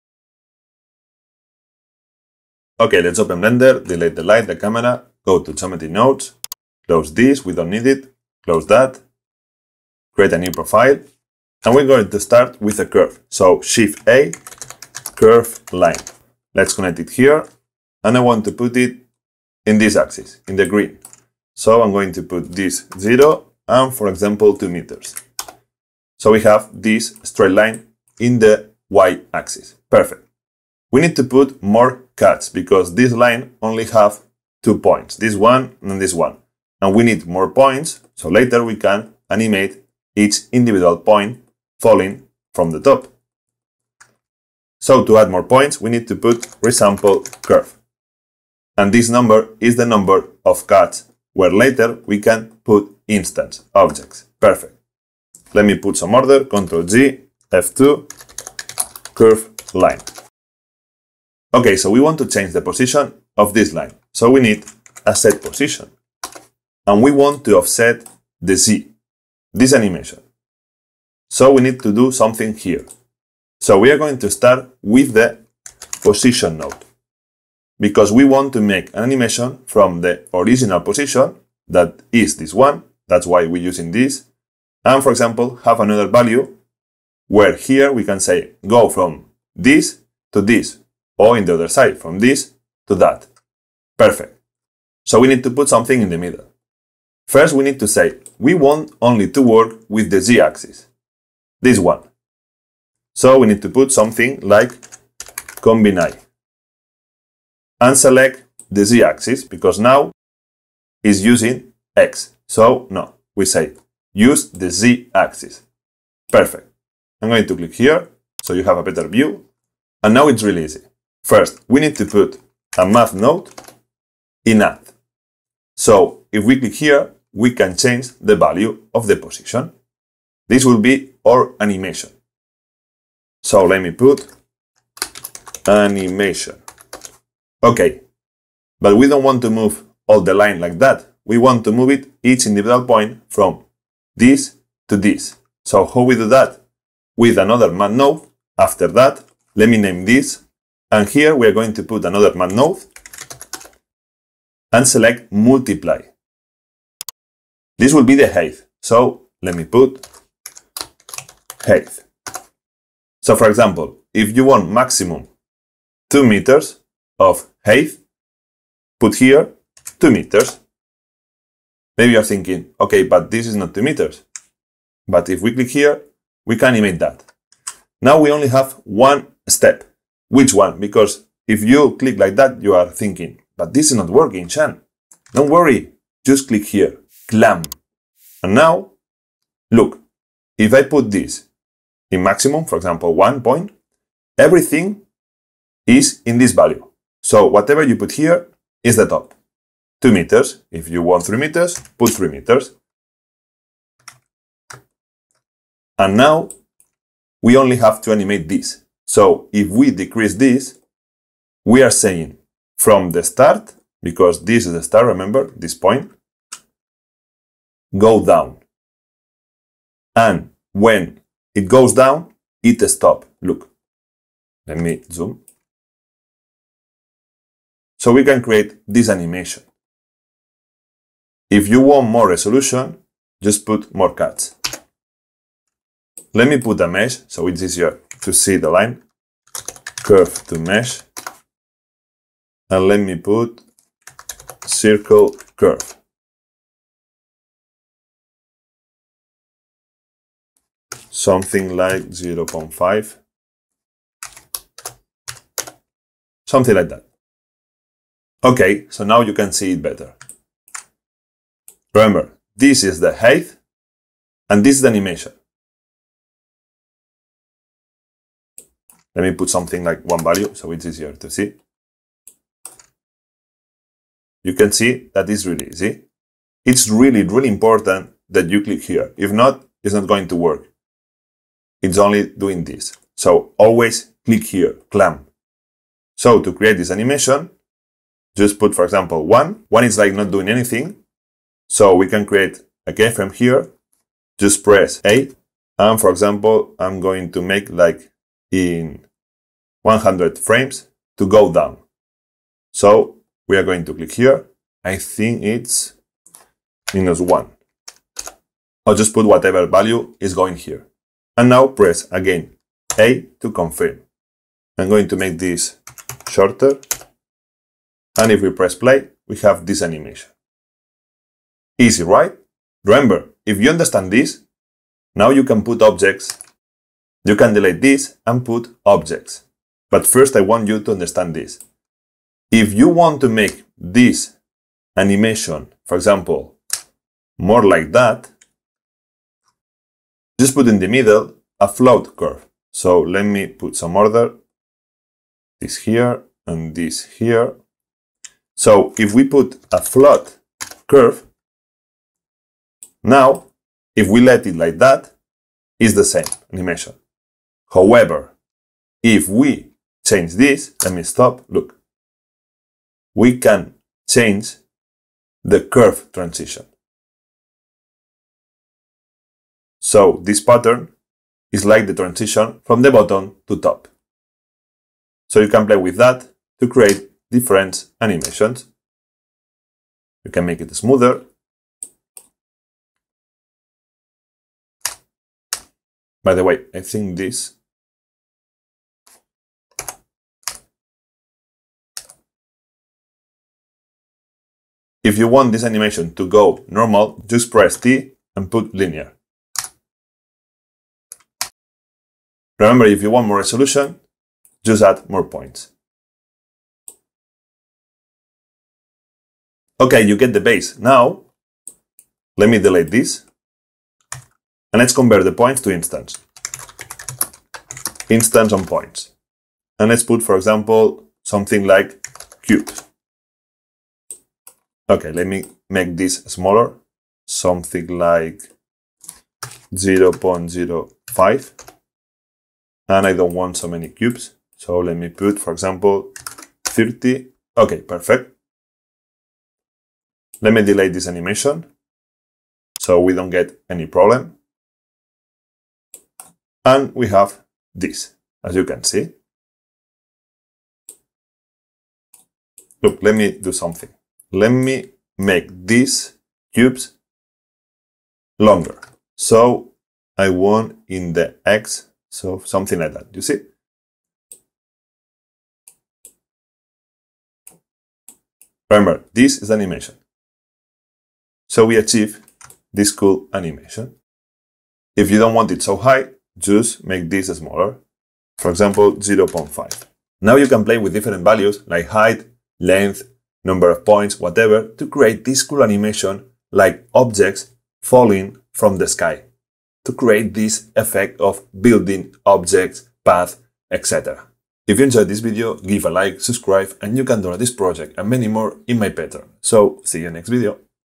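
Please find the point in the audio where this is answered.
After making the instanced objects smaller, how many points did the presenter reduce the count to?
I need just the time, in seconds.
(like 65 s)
436 s.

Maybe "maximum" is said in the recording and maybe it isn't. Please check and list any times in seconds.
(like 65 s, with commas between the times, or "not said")
164 s, 192 s.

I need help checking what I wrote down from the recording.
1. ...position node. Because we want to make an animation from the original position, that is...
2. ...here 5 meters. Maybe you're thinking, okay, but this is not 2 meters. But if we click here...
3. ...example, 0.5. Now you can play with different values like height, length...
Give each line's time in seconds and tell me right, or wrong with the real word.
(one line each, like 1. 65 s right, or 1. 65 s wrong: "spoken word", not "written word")
1. 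76 s right
2. 169 s wrong: "2", not "5"
3. 478 s right.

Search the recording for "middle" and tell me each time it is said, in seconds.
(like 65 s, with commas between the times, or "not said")
96 s, 340 s.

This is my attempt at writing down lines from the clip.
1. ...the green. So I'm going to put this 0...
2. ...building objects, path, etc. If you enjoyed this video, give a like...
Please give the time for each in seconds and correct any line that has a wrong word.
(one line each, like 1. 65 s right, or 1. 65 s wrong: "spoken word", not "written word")
1. 20 s right
2. 491 s right.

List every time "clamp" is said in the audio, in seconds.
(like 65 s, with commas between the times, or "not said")
187 s, 284 s.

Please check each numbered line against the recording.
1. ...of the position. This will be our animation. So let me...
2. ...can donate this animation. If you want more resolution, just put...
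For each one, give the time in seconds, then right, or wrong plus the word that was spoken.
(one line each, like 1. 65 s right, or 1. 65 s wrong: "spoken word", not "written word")
1. 128 s right
2. 228 s wrong: "create", not "donate".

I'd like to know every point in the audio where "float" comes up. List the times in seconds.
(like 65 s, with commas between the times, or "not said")
341 s, 349 s.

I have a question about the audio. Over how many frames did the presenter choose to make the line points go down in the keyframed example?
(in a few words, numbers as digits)
100.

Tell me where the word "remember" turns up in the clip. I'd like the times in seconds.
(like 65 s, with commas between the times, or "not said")
215 s, 261 s, 322 s, 402 s, 468 s.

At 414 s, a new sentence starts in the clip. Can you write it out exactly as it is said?
And let's compare the points to instance.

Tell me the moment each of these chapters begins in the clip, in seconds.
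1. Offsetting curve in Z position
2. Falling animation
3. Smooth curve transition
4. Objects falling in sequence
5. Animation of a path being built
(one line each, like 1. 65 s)
1. 61 s
2. 285 s
3. 332 s
4. 408 s
5. 452 s.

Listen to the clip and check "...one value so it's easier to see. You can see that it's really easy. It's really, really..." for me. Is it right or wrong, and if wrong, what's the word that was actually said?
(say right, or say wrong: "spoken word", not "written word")
right.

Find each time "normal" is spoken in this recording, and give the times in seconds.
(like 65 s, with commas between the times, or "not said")
396 s.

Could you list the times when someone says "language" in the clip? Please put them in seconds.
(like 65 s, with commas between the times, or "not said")
not said.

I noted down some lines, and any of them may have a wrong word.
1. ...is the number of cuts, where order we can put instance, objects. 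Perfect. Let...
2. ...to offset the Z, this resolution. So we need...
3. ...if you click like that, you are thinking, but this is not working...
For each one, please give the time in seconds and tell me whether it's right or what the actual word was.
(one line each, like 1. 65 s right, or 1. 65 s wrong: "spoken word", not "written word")
1. 49 s wrong: "later", not "order"
2. 67 s wrong: "animation", not "resolution"
3. 181 s right.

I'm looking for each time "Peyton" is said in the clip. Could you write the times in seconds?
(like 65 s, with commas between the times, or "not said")
not said.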